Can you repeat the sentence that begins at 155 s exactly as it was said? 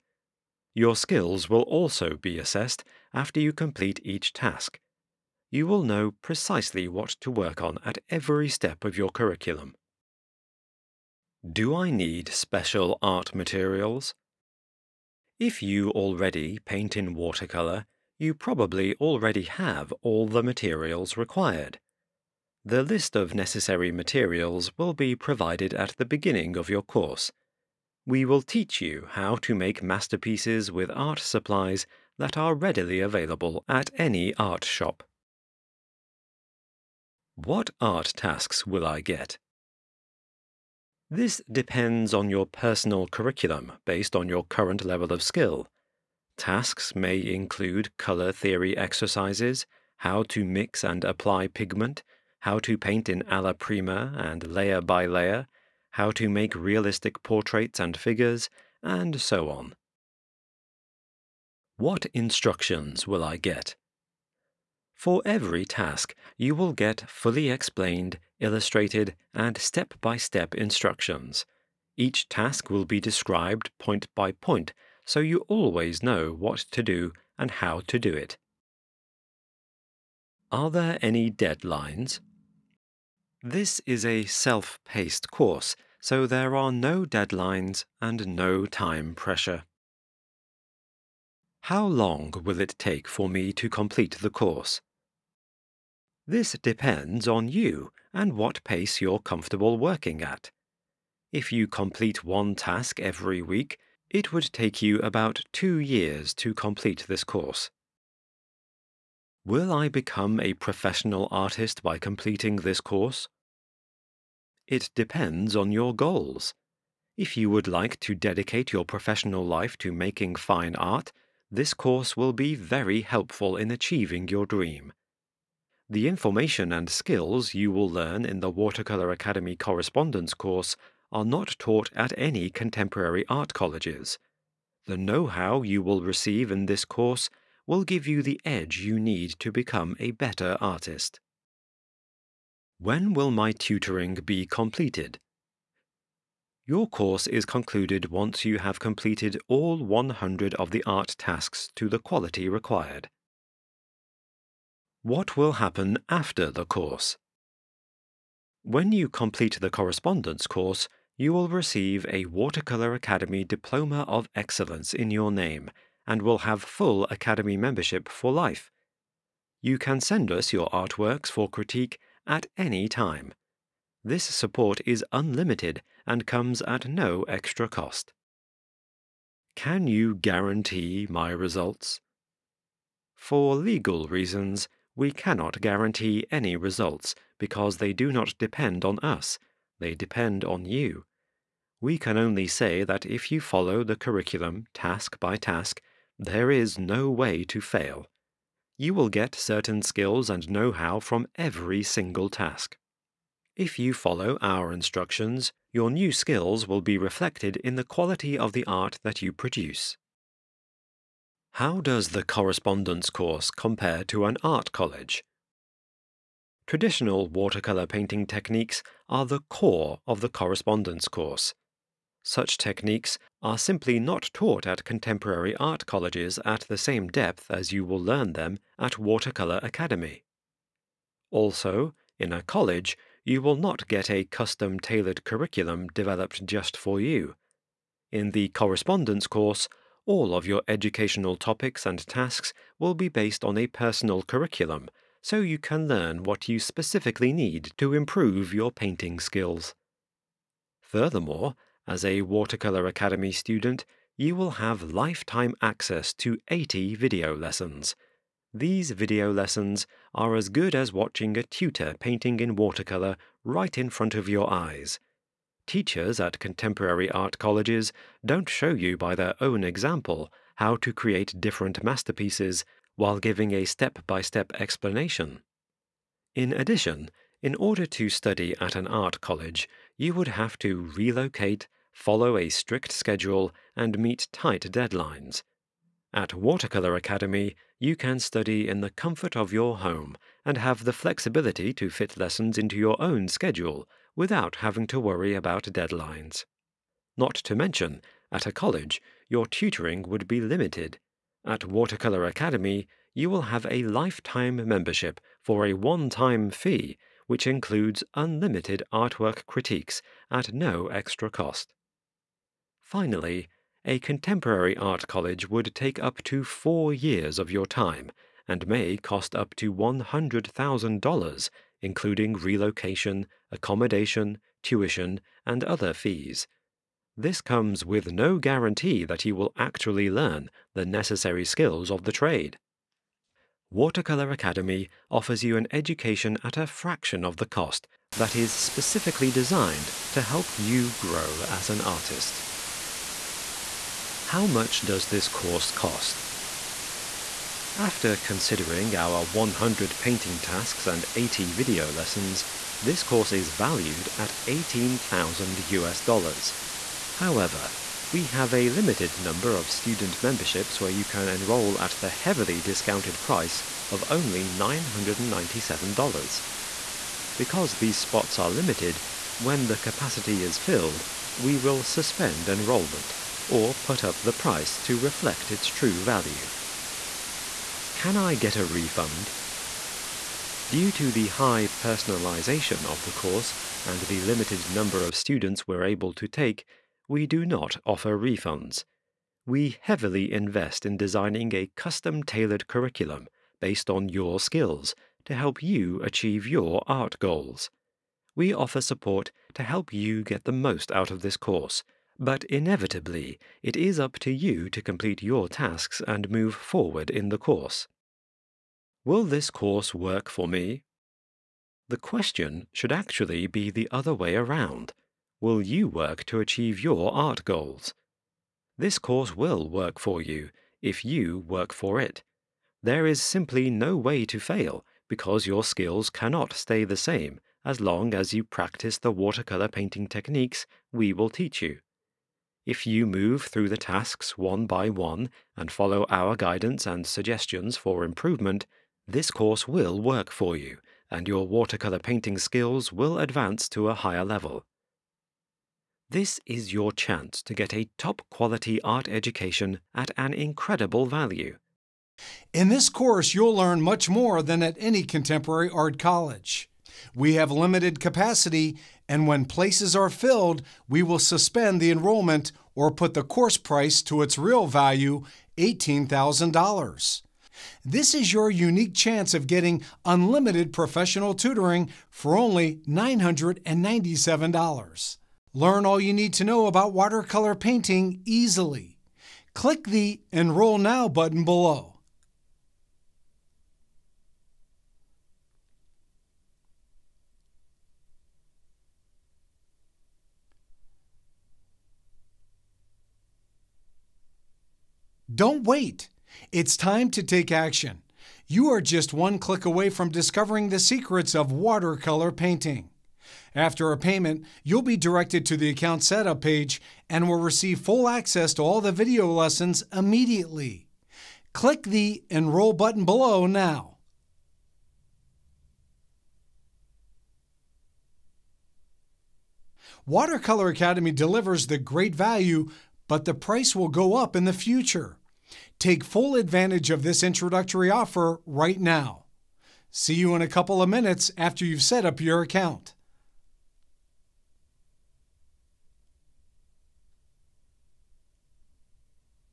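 What will happen after the course?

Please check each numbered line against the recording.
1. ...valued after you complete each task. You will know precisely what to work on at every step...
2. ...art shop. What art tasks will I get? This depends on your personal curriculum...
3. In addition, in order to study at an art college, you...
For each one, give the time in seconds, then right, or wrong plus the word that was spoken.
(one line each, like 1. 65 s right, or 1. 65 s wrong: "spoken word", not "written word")
1. 2 s wrong: "assessed", not "valued"
2. 34 s right
3. 276 s right.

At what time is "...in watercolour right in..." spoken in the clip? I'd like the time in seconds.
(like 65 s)
262 s.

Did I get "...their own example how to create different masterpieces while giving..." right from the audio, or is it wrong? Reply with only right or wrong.
right.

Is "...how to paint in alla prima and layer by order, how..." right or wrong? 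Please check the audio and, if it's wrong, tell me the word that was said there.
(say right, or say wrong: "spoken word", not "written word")
wrong: "layer", not "order".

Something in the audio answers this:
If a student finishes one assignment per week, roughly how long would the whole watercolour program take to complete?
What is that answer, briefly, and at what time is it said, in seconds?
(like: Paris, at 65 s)
about two years, at 104 s.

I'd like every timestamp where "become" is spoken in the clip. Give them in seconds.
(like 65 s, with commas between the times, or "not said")
109 s, 139 s.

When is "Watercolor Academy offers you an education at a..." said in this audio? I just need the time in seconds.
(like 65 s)
333 s.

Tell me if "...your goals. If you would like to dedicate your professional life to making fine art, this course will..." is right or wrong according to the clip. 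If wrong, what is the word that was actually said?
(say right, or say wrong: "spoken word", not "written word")
right.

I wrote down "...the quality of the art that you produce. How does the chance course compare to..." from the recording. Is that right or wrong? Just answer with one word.
wrong.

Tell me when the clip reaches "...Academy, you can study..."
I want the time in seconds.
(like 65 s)
286 s.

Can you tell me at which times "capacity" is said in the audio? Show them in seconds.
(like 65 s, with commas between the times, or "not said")
369 s, 457 s.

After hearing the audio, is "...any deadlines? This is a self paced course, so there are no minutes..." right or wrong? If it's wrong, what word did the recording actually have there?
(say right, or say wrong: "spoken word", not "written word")
wrong: "deadlines", not "minutes".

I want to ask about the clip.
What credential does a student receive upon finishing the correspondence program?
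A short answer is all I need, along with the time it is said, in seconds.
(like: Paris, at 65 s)
Diploma of Excellence, at 163 s.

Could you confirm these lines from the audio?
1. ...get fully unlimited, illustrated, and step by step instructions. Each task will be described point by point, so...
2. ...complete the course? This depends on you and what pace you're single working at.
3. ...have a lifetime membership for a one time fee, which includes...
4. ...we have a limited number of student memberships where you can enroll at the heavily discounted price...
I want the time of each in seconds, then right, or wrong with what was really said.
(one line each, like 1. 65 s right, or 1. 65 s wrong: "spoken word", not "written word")
1. 66 s wrong: "explained", not "unlimited"
2. 93 s wrong: "comfortable", not "single"
3. 303 s right
4. 358 s right.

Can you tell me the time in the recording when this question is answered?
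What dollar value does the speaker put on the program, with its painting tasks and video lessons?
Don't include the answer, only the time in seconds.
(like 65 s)
354 s.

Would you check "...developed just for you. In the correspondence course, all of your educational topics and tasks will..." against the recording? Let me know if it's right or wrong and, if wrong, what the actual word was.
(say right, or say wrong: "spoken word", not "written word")
right.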